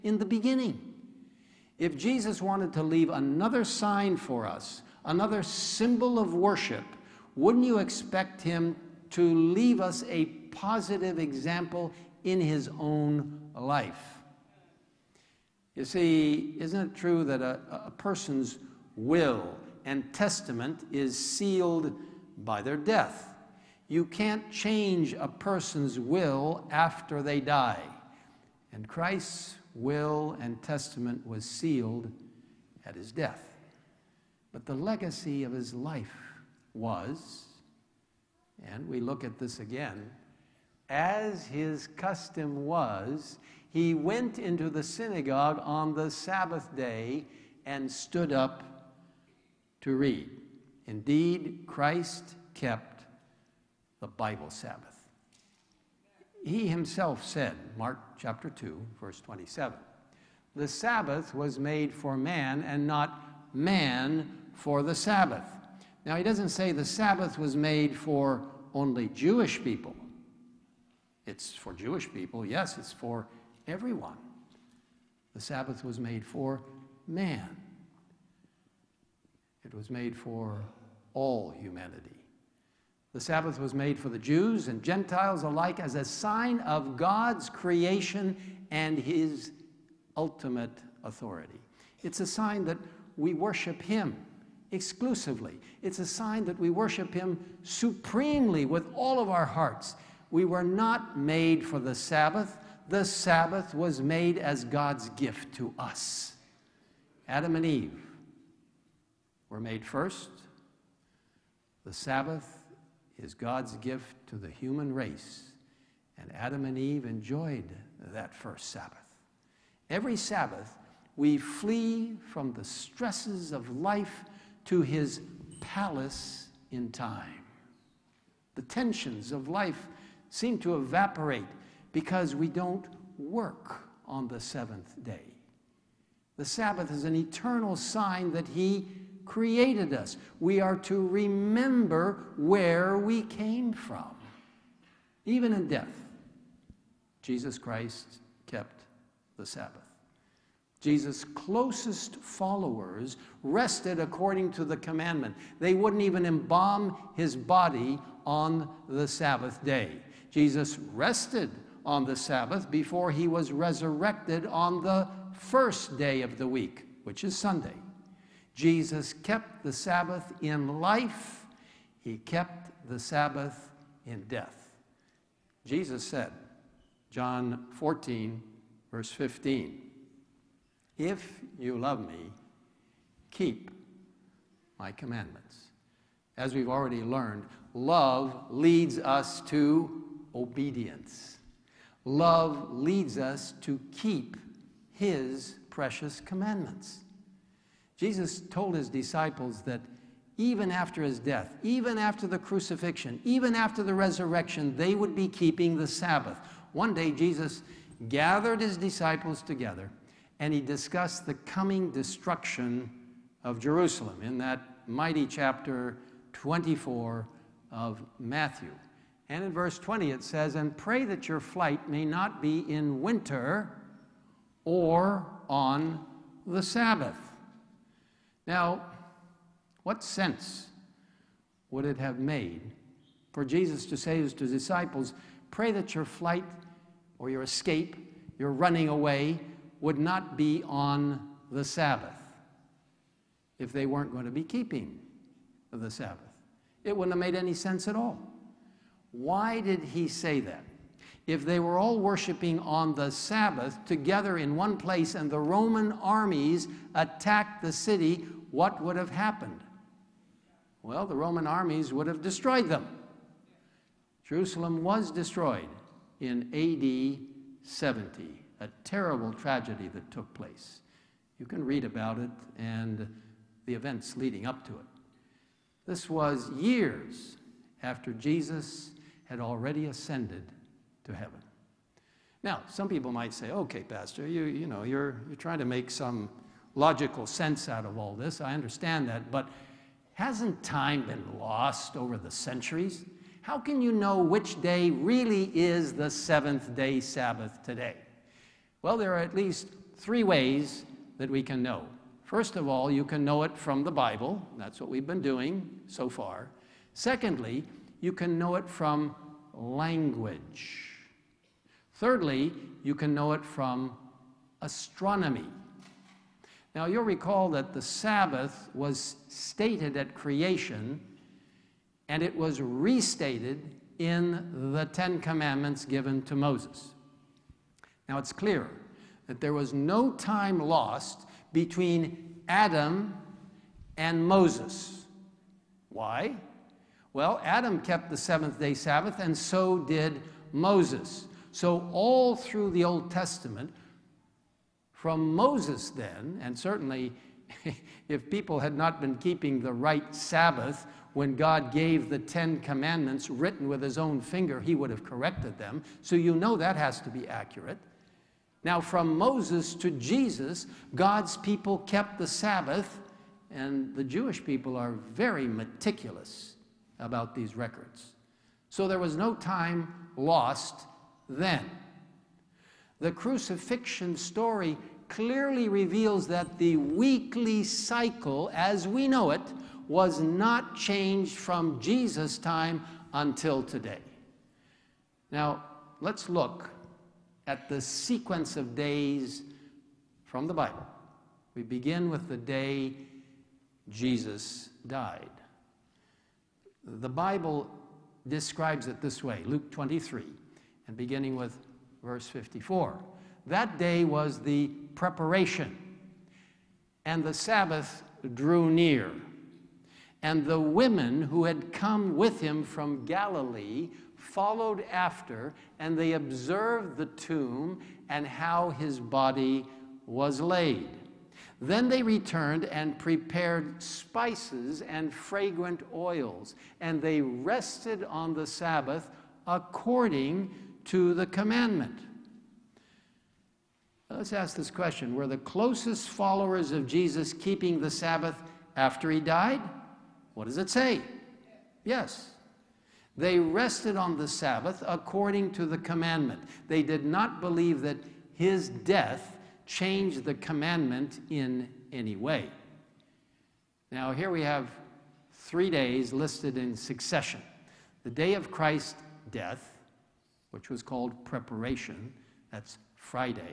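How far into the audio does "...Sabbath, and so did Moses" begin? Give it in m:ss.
5:38.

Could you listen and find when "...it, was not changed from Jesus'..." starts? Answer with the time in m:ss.
6:19.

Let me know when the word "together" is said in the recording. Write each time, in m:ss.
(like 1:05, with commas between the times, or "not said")
3:29, 4:13.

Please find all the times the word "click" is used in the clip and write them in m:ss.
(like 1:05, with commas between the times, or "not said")
not said.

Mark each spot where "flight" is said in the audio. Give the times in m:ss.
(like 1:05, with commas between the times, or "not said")
3:41, 3:56.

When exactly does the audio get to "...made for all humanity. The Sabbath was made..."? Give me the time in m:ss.
1:19.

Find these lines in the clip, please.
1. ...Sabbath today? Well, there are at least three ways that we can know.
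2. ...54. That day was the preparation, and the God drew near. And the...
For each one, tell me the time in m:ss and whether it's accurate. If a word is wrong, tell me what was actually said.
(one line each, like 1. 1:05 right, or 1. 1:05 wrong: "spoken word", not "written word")
1. 4:56 right
2. 6:42 wrong: "Sabbath", not "God".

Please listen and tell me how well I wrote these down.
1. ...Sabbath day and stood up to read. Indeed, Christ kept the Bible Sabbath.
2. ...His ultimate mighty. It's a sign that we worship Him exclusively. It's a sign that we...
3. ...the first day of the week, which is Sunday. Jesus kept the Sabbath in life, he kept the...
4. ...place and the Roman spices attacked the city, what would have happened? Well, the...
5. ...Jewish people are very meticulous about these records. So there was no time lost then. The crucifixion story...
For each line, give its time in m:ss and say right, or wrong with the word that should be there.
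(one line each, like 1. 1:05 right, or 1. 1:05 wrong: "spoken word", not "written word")
1. 0:46 right
2. 1:28 wrong: "authority", not "mighty"
3. 2:44 right
4. 4:14 wrong: "armies", not "spices"
5. 6:04 right.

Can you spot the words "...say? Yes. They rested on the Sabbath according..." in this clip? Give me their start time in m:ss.
7:20.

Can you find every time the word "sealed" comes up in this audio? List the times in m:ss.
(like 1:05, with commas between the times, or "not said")
0:21, 0:31.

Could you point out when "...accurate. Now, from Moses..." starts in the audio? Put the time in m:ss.
5:57.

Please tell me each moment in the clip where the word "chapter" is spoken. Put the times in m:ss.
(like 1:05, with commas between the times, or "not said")
0:58, 3:35.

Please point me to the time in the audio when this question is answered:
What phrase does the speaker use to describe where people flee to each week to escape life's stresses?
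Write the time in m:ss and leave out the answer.
2:04.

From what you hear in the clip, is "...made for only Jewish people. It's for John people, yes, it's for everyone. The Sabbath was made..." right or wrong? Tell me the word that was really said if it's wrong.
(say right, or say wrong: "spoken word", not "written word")
wrong: "Jewish", not "John".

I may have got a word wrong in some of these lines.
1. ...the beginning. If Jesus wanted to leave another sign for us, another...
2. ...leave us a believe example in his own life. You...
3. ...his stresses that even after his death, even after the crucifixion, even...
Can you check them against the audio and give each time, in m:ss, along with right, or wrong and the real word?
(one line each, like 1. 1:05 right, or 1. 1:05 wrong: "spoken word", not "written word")
1. 0:00 right
2. 0:09 wrong: "positive", not "believe"
3. 3:18 wrong: "disciples", not "stresses".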